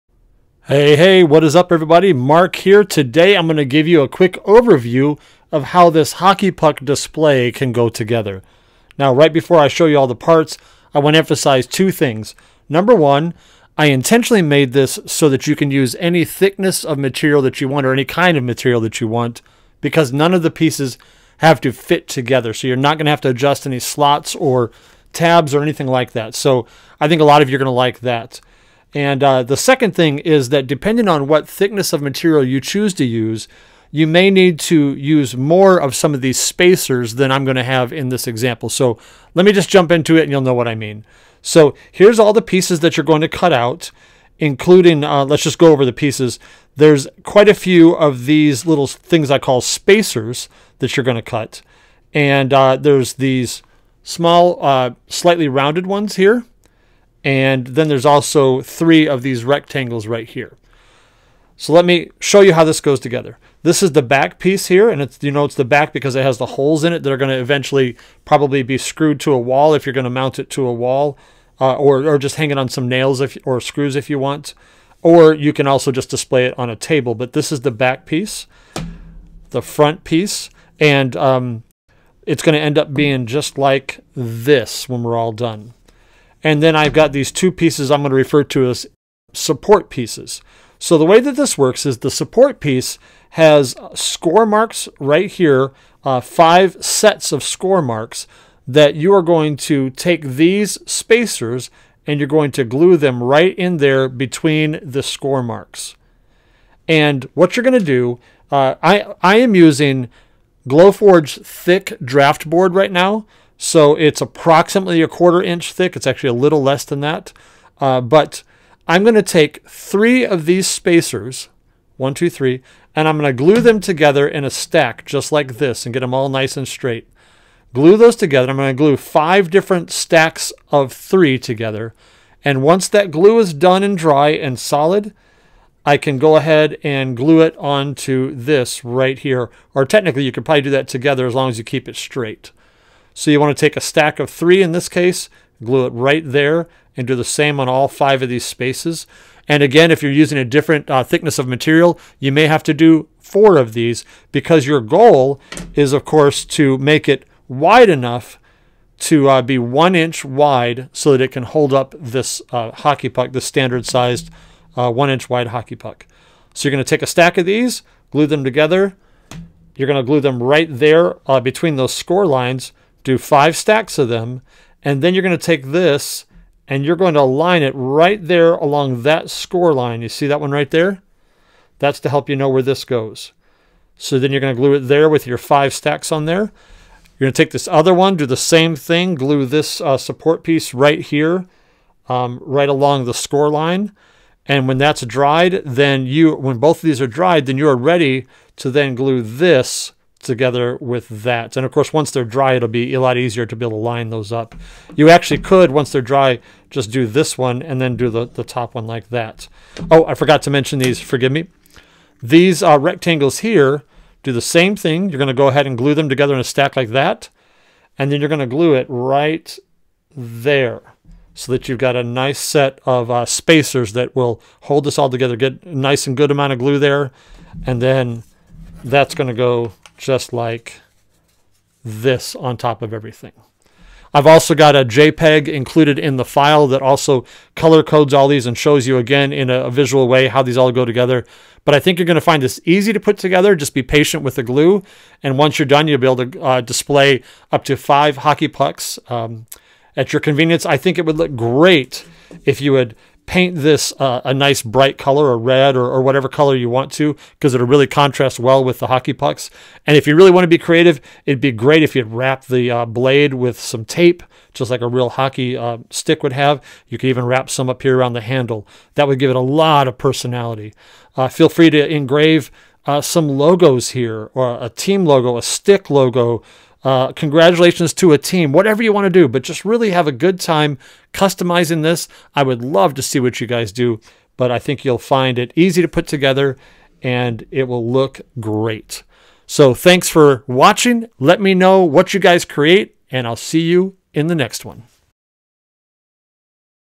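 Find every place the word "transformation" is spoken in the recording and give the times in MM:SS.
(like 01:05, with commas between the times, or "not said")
not said.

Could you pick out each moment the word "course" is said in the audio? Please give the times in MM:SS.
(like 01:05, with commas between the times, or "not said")
02:36, 03:21.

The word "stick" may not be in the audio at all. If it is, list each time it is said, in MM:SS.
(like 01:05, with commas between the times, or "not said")
04:25, 04:35.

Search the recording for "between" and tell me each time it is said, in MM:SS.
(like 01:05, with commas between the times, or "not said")
01:44, 02:51.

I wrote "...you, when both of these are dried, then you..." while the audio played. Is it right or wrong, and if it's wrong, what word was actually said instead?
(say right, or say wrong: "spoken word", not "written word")
right.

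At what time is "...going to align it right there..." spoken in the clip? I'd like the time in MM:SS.
02:56.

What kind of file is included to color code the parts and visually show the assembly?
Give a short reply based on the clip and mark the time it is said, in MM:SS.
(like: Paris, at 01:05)
JPEG, at 03:54.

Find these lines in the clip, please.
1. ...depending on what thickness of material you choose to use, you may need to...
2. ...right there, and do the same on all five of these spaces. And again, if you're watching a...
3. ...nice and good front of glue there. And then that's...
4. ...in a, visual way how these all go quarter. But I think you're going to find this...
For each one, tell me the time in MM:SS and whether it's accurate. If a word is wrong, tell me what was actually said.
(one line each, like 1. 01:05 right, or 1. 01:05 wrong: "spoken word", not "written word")
1. 00:30 right
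2. 02:25 wrong: "using", not "watching"
3. 03:45 wrong: "amount", not "front"
4. 03:59 wrong: "together", not "quarter".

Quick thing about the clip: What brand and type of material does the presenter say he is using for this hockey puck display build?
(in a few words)
Glowforge thick draft board.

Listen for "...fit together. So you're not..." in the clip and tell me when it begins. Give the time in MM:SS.
00:21.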